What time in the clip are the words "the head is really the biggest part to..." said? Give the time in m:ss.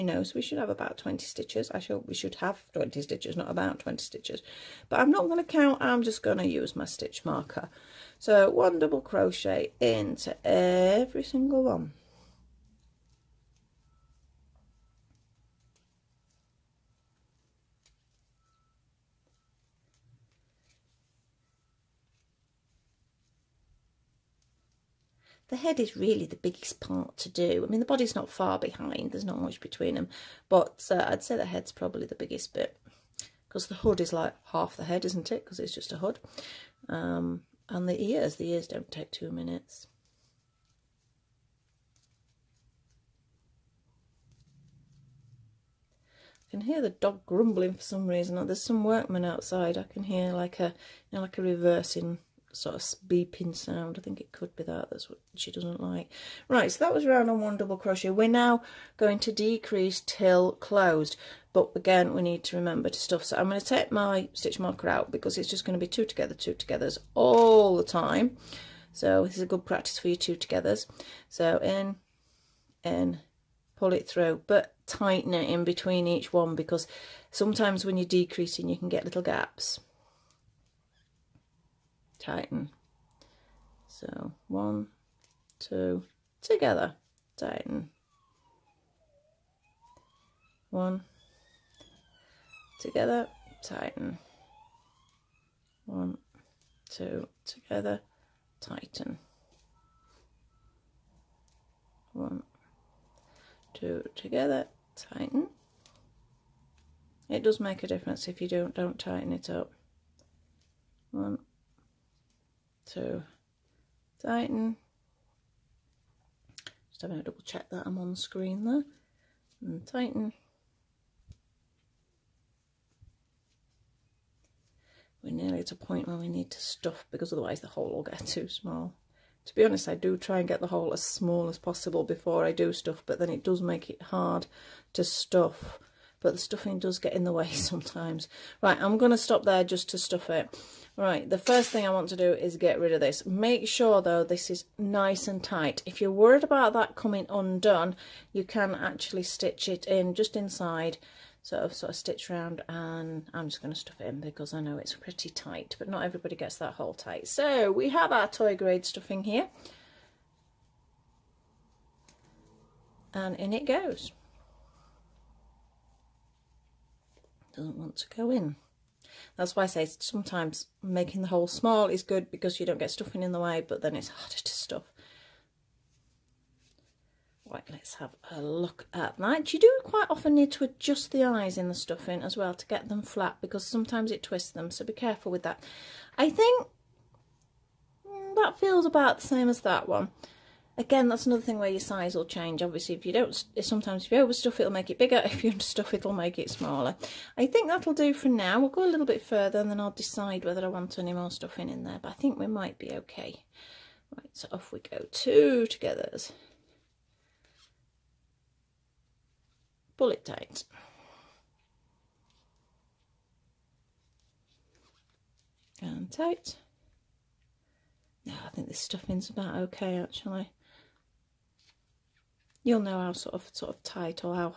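0:25.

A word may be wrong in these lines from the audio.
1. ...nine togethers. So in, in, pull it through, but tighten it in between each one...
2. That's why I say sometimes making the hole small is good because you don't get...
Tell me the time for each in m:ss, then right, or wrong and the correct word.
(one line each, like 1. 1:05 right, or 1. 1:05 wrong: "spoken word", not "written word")
1. 1:10 wrong: "two", not "nine"
2. 2:49 right.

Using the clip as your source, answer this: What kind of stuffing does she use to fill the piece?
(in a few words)
toy grade stuffing.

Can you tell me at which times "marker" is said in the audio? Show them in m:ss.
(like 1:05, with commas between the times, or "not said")
0:07, 1:04.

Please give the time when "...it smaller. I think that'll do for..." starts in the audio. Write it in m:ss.
3:16.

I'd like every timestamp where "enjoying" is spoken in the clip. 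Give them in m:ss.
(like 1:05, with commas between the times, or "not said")
not said.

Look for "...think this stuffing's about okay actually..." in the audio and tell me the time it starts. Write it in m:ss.
3:38.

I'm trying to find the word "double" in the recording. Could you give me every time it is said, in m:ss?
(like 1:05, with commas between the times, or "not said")
0:08, 0:57, 1:57.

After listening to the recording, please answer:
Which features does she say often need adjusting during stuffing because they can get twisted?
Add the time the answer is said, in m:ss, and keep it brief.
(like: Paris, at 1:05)
the eyes, at 3:01.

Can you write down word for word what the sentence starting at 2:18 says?
Right, I'm going to stop there just to stuff it.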